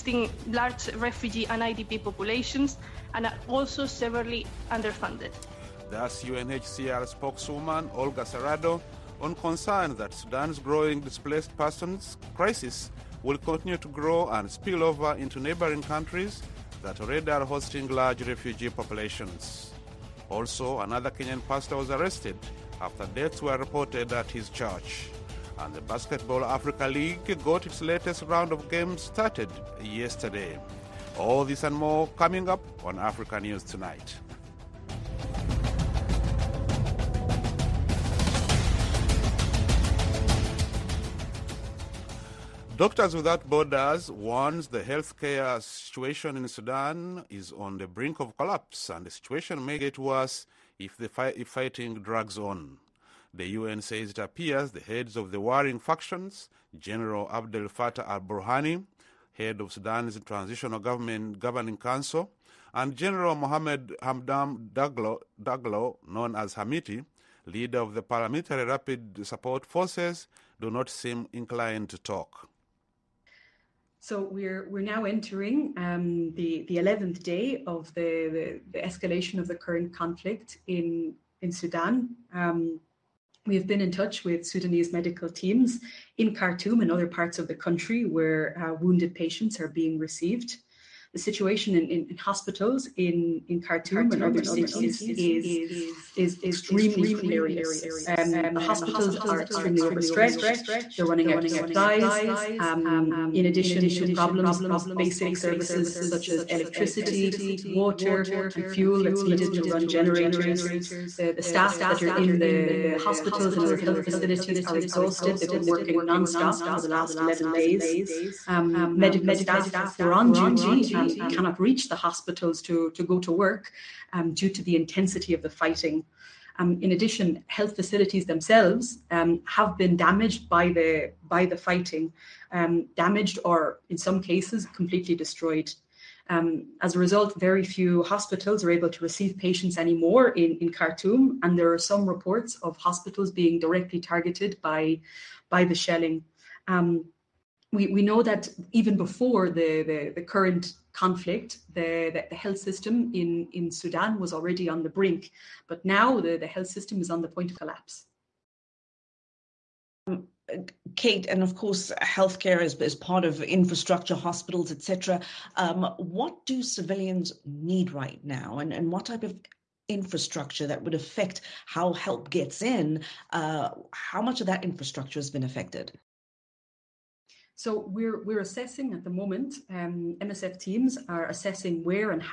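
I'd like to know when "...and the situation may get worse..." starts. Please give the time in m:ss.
0:48.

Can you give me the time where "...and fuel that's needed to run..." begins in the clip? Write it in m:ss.
1:48.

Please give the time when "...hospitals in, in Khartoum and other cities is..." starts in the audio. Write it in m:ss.
1:32.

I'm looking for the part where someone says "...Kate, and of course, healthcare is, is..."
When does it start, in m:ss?
2:40.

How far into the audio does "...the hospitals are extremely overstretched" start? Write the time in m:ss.
1:38.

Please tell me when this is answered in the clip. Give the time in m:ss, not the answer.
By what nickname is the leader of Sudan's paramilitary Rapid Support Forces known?
1:06.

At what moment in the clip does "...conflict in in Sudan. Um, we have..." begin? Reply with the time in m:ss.
1:19.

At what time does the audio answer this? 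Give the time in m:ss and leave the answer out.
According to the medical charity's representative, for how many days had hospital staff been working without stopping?
1:57.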